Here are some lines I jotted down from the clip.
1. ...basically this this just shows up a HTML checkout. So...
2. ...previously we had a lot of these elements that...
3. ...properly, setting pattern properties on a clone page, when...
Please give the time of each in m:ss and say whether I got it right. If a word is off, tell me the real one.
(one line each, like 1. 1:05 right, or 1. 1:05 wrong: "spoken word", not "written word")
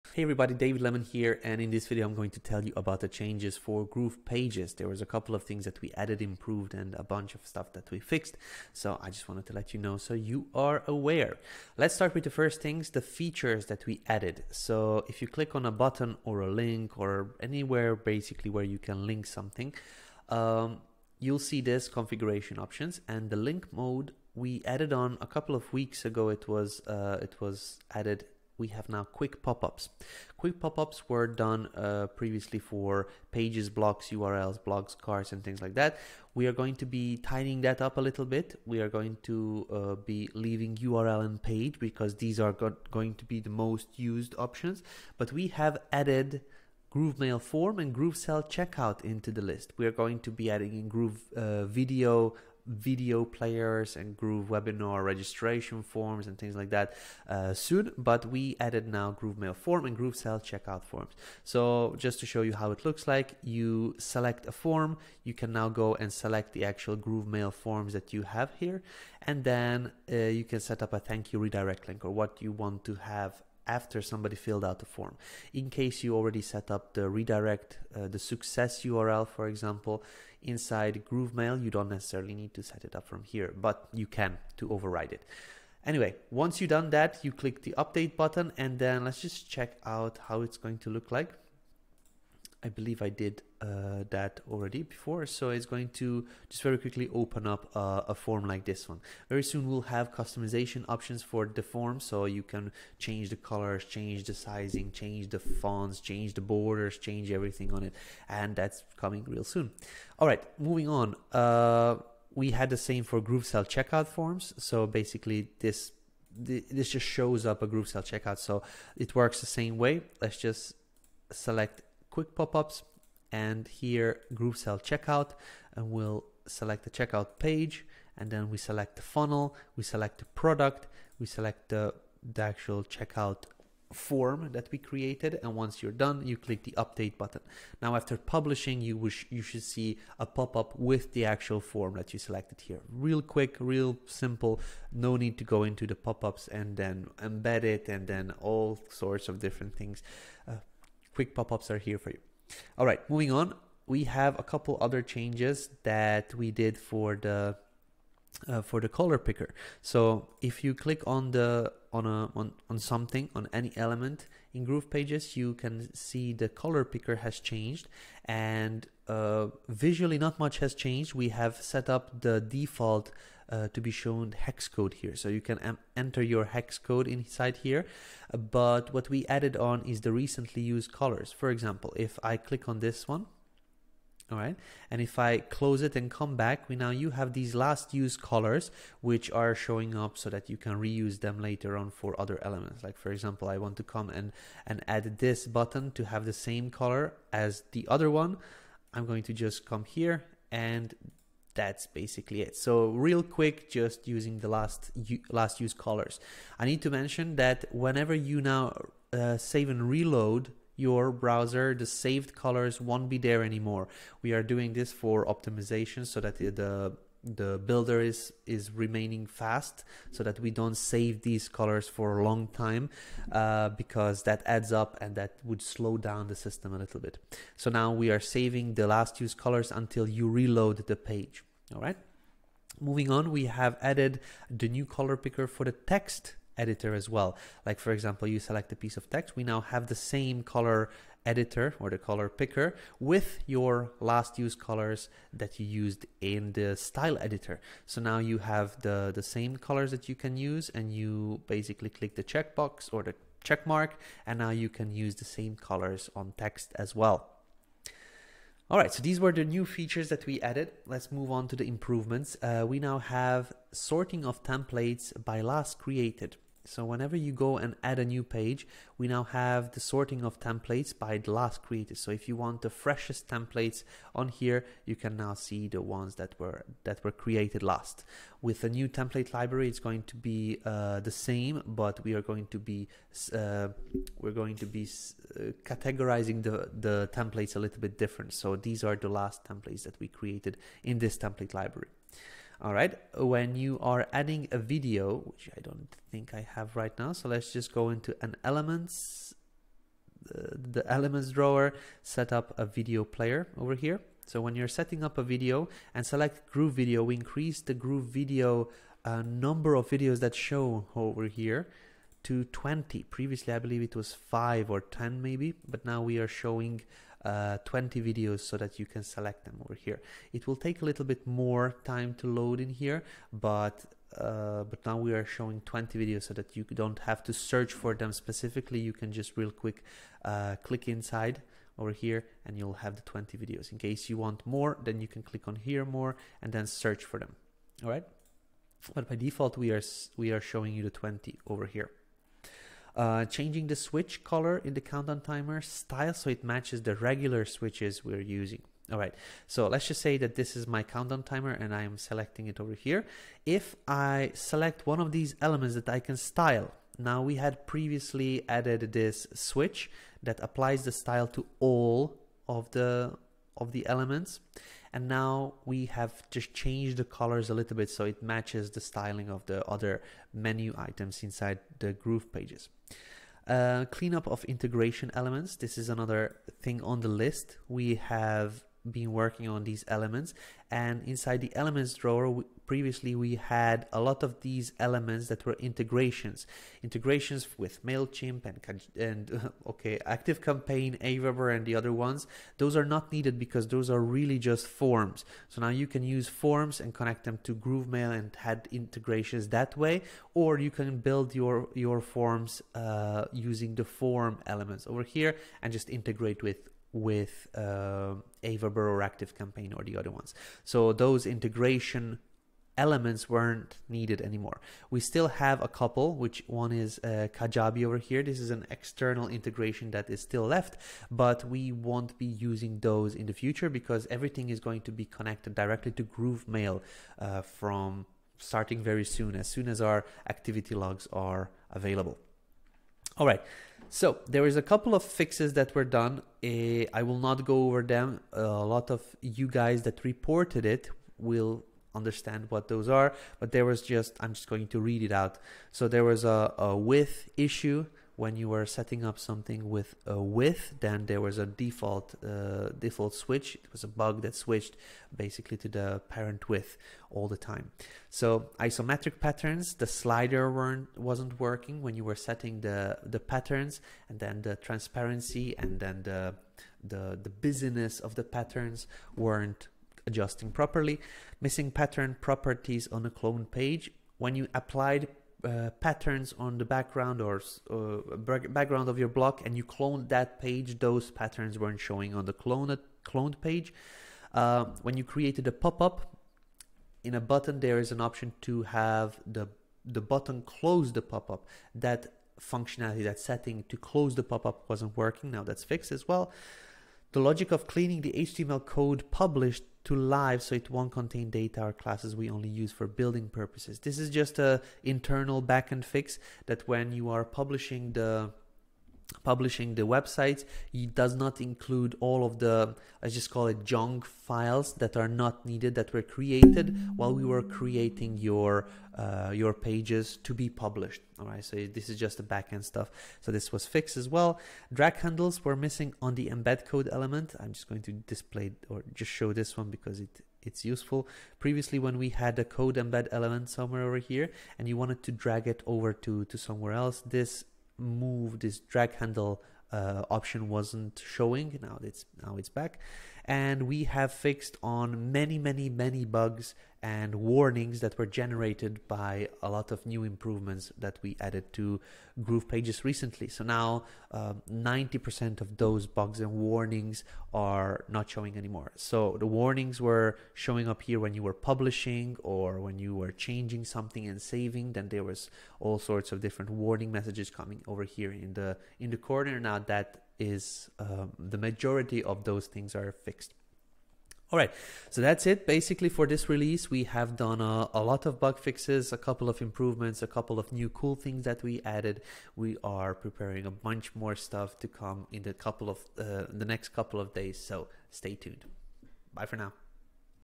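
1. 1:54 wrong: "Sell", not "HTML"
2. 6:22 right
3. 7:50 wrong: "missing", not "setting".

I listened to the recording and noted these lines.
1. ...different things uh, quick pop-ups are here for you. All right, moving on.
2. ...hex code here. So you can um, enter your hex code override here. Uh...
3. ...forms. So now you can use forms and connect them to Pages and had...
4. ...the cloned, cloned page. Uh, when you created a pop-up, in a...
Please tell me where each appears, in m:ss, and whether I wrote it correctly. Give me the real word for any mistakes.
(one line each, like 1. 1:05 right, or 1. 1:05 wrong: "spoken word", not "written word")
1. 2:29 right
2. 2:54 wrong: "inside", not "override"
3. 6:34 wrong: "GrooveMail", not "Pages"
4. 8:02 right.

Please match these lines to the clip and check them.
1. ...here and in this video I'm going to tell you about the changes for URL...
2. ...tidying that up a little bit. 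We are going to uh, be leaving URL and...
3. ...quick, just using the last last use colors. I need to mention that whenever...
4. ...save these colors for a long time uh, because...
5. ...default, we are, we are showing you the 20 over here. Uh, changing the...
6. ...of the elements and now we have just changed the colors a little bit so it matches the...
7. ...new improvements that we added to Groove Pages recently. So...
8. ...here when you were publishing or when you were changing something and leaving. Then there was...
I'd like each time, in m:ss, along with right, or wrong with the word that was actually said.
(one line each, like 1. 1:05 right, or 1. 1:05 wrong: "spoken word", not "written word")
1. 0:01 wrong: "Groove", not "URL"
2. 0:37 right
3. 3:23 right
4. 3:40 right
5. 5:39 right
6. 6:03 right
7. 9:09 right
8. 9:20 wrong: "saving", not "leaving".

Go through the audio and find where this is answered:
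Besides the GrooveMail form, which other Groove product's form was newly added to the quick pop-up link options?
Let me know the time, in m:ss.
0:47.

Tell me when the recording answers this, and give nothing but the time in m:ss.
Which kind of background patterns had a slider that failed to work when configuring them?
7:38.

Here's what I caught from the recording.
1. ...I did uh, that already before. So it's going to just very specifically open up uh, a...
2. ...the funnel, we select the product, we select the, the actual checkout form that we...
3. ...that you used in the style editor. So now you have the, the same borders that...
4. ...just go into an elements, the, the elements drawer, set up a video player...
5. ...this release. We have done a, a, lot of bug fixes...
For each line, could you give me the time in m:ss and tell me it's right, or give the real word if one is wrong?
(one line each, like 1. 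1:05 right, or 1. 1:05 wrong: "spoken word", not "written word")
1. 1:33 wrong: "quickly", not "specifically"
2. 2:08 right
3. 4:05 wrong: "colors", not "borders"
4. 4:57 right
5. 9:36 right.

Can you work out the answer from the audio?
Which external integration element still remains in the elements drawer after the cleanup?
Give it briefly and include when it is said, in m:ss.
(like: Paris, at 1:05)
Kajabi, at 6:57.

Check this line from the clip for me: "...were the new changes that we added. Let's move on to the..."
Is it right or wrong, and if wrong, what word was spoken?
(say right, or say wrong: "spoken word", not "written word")
wrong: "features", not "changes".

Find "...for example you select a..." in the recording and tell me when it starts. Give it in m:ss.
3:57.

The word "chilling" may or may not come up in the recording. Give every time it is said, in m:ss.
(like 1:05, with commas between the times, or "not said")
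not said.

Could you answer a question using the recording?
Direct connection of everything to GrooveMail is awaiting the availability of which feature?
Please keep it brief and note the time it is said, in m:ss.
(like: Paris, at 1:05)
Activity logs, at 7:10.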